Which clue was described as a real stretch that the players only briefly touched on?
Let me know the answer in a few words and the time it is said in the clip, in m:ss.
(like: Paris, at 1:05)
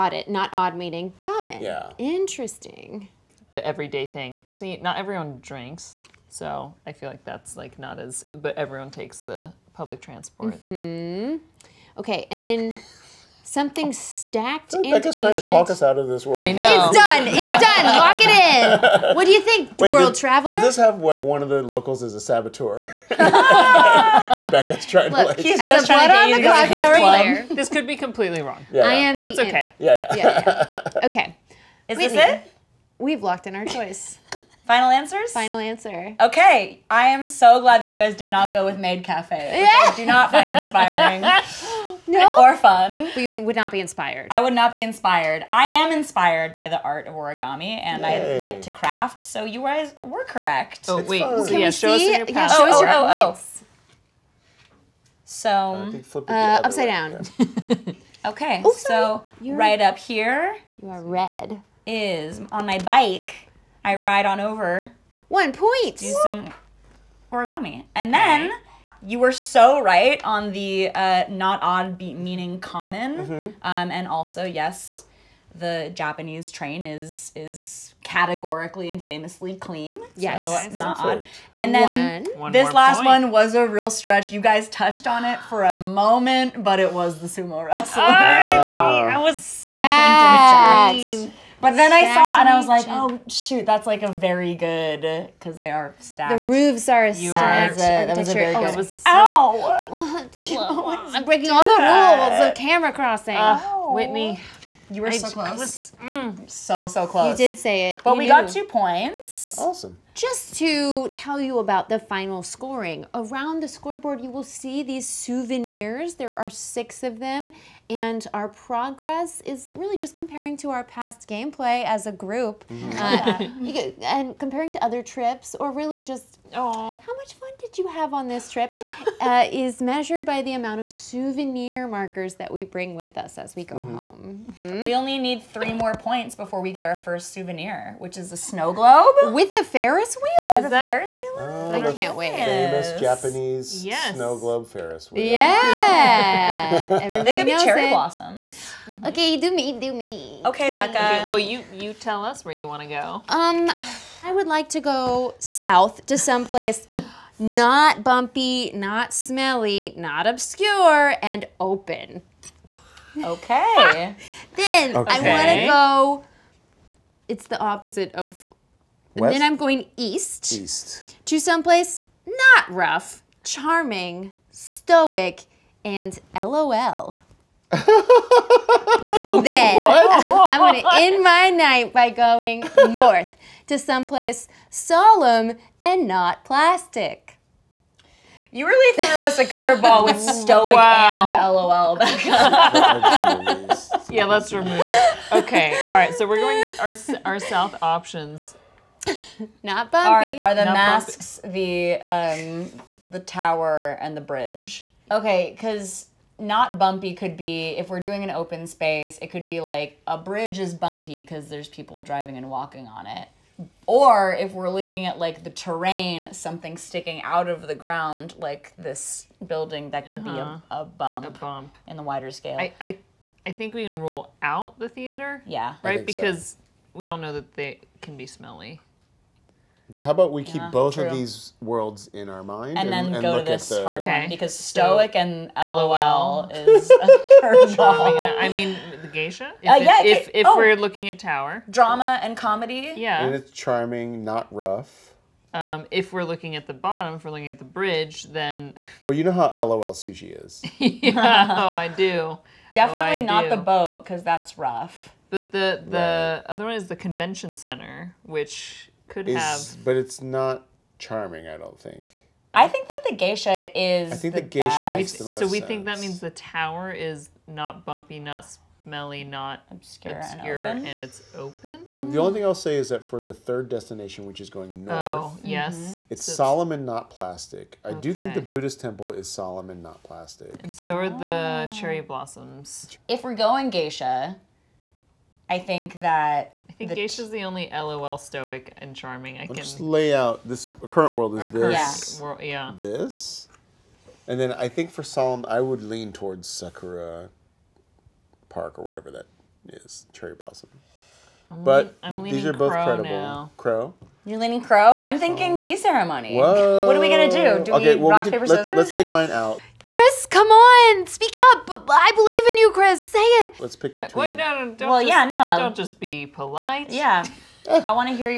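the sumo wrestler, at 1:27.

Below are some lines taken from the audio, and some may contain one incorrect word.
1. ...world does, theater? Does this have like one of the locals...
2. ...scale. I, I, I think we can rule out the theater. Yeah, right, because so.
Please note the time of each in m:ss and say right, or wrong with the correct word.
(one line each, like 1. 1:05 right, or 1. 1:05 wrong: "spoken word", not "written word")
1. 0:19 wrong: "traveler", not "theater"
2. 3:42 right.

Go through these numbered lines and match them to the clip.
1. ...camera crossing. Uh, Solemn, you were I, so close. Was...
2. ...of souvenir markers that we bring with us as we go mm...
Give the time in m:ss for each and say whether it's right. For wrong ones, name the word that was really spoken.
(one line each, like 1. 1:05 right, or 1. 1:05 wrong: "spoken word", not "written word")
1. 1:42 wrong: "Whitney", not "Solemn"
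2. 2:10 right.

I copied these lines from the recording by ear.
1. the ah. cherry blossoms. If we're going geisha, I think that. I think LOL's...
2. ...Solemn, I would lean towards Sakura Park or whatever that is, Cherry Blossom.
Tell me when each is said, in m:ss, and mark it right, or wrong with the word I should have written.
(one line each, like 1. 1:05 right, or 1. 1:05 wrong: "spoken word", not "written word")
1. 4:41 wrong: "Geisha", not "LOL"
2. 4:55 right.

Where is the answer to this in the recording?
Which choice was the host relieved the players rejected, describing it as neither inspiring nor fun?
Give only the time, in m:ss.
0:38.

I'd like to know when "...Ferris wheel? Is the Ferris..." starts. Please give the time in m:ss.
2:19.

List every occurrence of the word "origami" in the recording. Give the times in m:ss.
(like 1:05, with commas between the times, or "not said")
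0:47, 1:07.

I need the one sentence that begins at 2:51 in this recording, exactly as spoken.
To someplace not rough, charming, stoic, and LOL.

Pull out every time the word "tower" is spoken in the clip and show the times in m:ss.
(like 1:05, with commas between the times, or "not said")
3:23, 4:01, 4:26.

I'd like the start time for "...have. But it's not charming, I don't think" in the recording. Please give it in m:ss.
4:19.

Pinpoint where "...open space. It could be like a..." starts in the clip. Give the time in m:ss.
3:28.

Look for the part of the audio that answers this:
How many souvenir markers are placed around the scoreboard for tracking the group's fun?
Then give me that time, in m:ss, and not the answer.
1:56.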